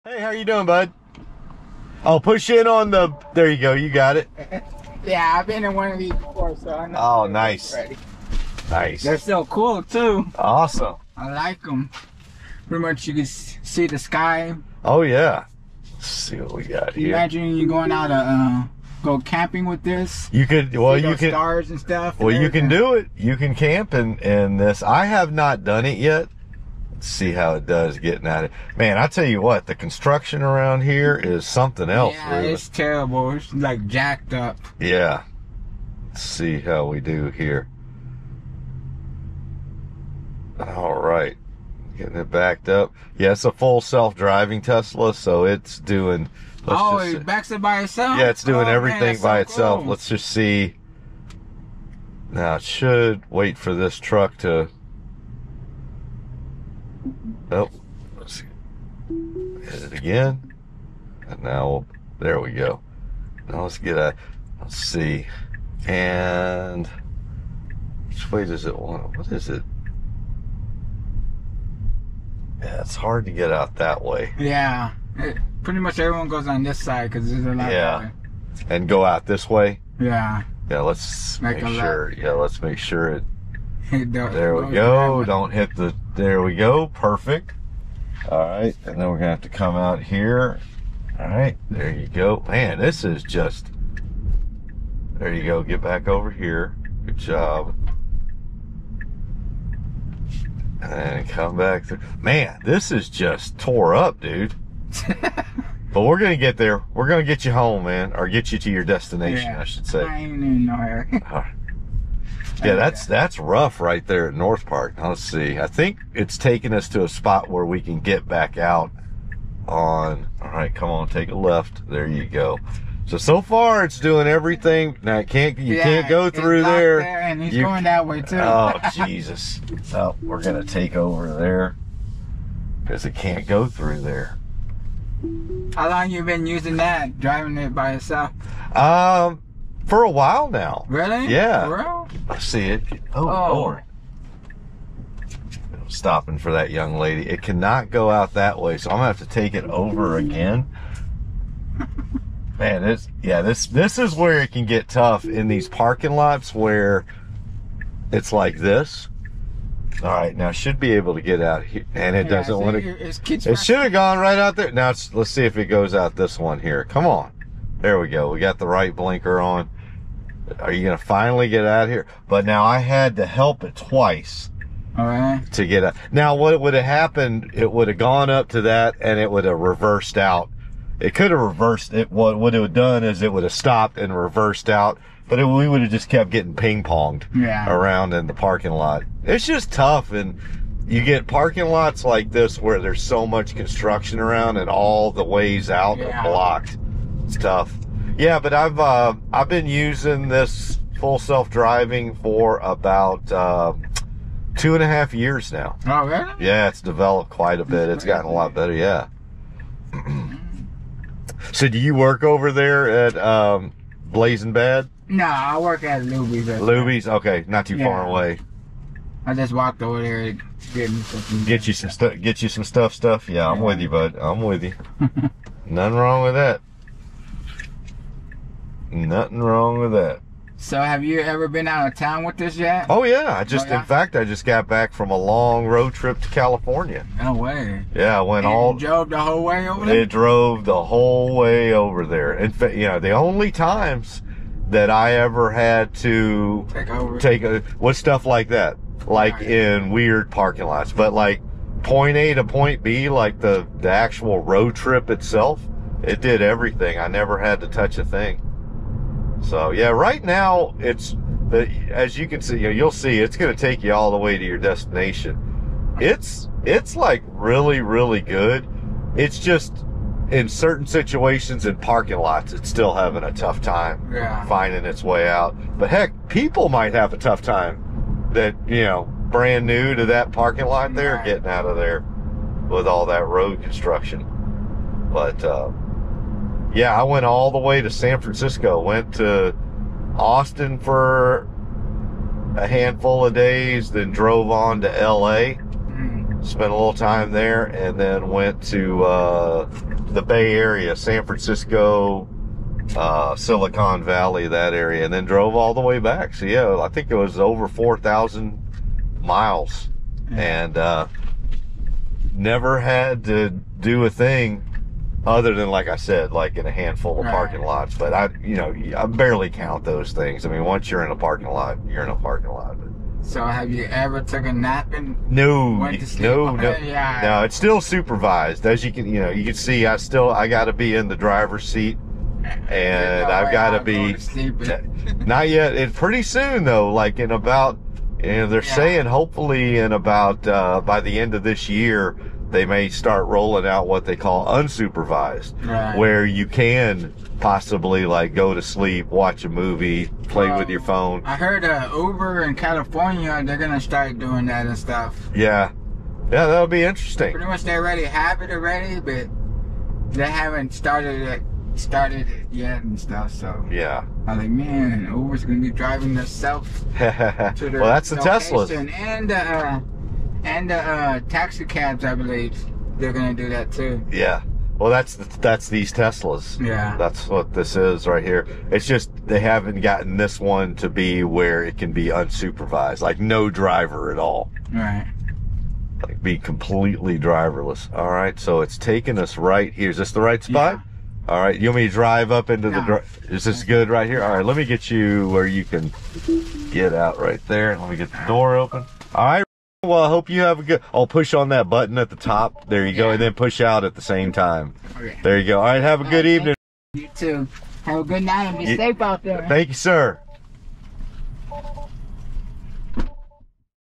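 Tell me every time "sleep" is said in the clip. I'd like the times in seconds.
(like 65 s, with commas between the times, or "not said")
326 s, 348 s.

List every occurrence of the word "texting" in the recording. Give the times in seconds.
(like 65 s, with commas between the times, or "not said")
not said.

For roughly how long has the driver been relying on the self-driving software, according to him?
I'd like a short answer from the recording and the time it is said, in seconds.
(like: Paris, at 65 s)
Two and a half years, at 202 s.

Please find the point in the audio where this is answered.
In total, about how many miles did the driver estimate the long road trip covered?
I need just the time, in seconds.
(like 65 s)
307 s.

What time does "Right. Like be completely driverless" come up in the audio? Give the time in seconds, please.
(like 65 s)
384 s.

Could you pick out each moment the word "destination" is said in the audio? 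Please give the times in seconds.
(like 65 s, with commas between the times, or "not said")
108 s, 264 s.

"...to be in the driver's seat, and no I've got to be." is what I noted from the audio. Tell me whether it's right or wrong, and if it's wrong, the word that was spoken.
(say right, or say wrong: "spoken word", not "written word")
right.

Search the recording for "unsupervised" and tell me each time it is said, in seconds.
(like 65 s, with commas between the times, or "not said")
344 s, 382 s.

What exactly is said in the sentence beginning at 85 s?
Don't hit the there we go, perfect.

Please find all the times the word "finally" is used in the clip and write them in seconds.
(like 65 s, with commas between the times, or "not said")
170 s.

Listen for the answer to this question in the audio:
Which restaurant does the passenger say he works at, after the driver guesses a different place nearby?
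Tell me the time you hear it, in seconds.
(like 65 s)
215 s.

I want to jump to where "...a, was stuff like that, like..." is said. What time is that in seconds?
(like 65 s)
247 s.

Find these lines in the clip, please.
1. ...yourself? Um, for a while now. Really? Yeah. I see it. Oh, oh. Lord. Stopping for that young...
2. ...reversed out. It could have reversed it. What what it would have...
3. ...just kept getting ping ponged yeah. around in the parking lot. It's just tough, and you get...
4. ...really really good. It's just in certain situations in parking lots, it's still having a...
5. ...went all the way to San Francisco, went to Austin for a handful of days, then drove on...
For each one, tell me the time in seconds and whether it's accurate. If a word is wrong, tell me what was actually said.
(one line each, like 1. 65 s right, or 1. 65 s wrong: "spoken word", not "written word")
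1. 137 s right
2. 179 s right
3. 185 s right
4. 267 s right
5. 287 s right.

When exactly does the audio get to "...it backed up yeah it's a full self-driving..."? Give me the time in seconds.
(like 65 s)
42 s.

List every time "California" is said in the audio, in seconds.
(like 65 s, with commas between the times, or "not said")
236 s, 352 s.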